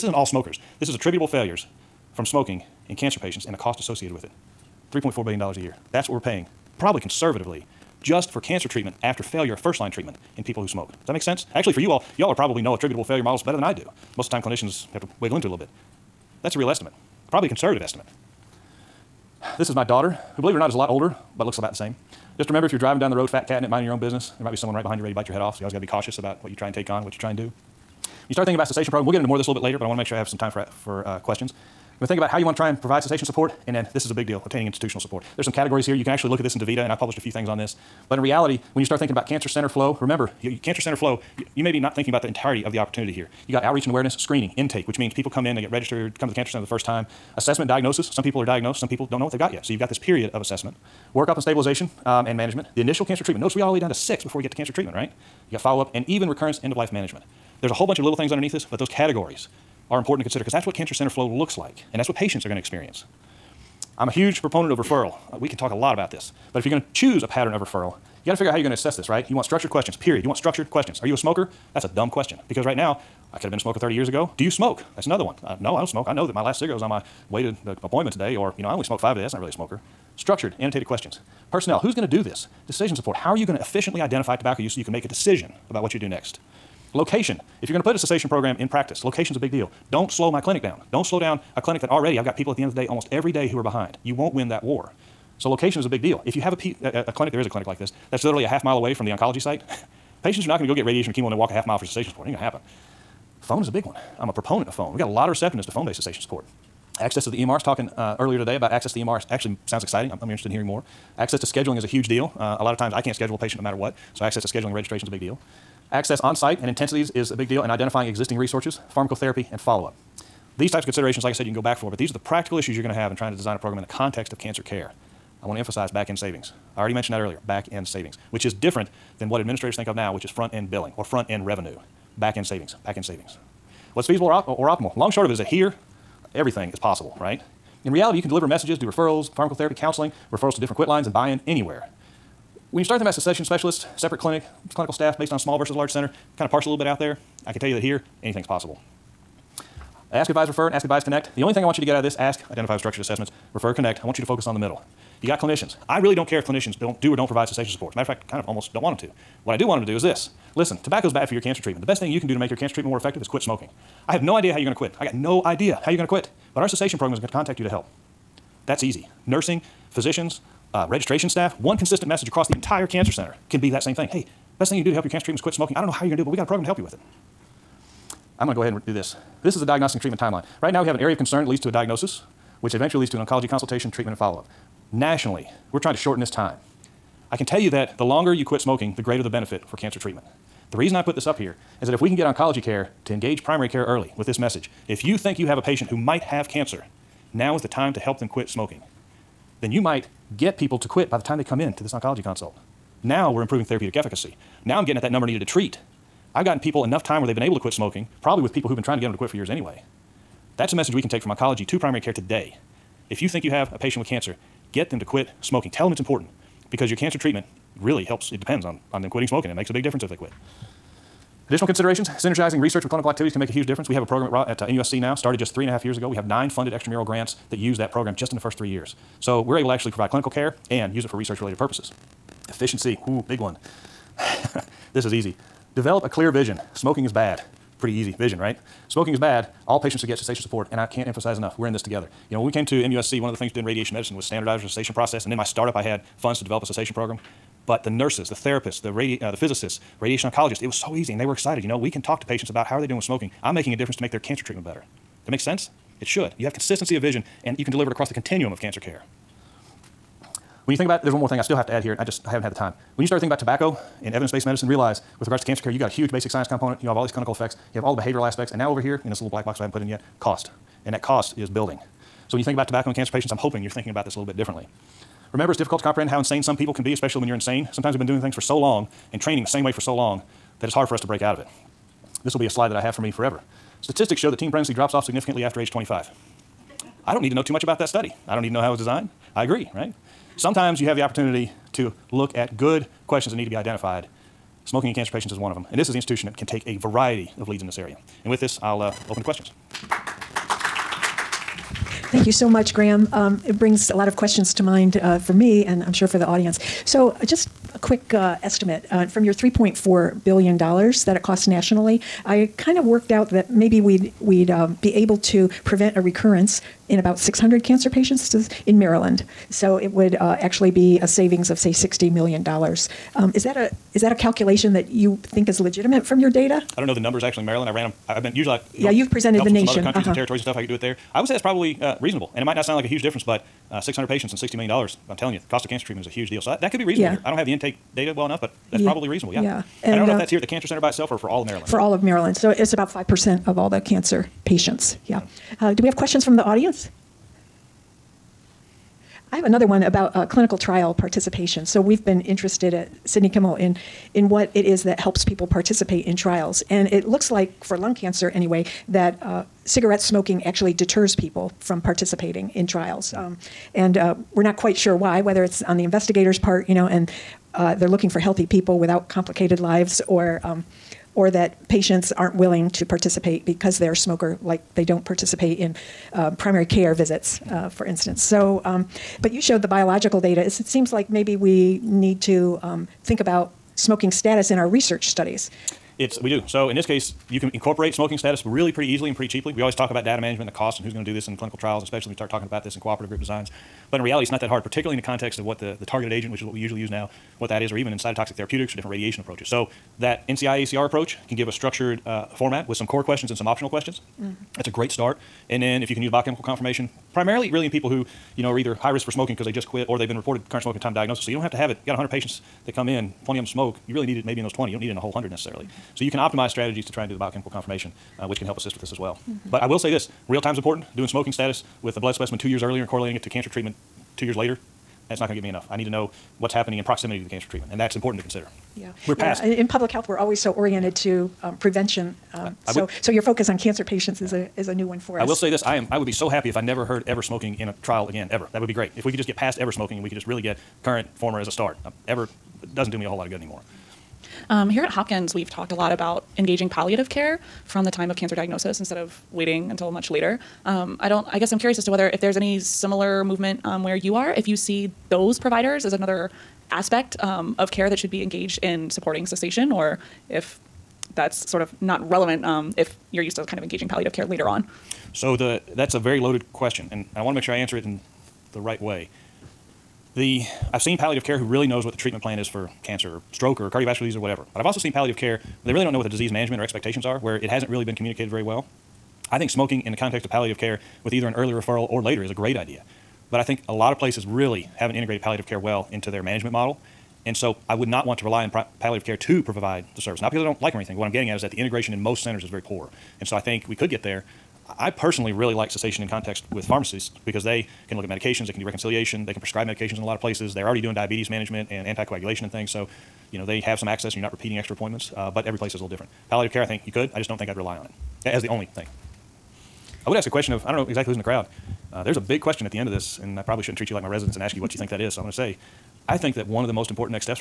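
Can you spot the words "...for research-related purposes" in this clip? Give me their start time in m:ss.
3:51.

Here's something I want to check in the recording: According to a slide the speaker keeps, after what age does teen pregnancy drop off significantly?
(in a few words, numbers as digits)
25.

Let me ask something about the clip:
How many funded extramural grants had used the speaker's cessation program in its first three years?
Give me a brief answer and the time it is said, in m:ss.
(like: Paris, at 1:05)
9, at 3:46.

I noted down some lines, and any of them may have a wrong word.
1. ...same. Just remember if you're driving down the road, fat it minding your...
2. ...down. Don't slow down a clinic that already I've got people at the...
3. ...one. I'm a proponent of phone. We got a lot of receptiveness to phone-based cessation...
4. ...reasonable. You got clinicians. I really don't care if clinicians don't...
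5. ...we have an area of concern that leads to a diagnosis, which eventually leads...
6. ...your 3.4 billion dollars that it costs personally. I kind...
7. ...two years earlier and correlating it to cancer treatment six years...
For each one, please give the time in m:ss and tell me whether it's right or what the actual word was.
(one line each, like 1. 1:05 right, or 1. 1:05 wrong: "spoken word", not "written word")
1. 0:21 right
2. 1:30 right
3. 1:43 right
4. 2:34 wrong: "middle", not "reasonable"
5. 3:00 right
6. 5:09 wrong: "nationally", not "personally"
7. 7:02 wrong: "two", not "six".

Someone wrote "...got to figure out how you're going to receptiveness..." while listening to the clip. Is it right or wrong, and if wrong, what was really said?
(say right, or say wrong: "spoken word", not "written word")
wrong: "assess", not "receptiveness".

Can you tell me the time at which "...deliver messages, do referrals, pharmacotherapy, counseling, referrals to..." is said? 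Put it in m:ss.
2:18.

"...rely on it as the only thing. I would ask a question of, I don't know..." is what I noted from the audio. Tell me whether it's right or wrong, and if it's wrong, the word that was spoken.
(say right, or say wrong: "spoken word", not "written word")
right.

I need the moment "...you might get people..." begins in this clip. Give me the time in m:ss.
3:19.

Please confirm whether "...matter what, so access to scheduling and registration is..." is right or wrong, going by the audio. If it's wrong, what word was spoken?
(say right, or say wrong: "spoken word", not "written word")
right.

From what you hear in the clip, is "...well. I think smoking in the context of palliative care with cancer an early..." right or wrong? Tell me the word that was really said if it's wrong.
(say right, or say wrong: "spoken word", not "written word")
wrong: "either", not "cancer".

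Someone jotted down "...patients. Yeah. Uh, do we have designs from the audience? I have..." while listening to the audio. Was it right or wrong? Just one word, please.
wrong.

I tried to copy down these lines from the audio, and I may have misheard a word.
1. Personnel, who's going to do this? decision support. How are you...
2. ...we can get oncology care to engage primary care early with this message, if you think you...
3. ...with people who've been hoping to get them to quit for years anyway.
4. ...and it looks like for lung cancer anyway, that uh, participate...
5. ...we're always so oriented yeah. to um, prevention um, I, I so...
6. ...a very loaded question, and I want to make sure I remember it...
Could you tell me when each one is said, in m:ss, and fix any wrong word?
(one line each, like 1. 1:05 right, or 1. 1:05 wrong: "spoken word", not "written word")
1. 1:21 right
2. 3:12 right
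3. 3:28 wrong: "trying", not "hoping"
4. 5:56 wrong: "cigarette", not "participate"
5. 7:10 right
6. 7:45 wrong: "answer", not "remember".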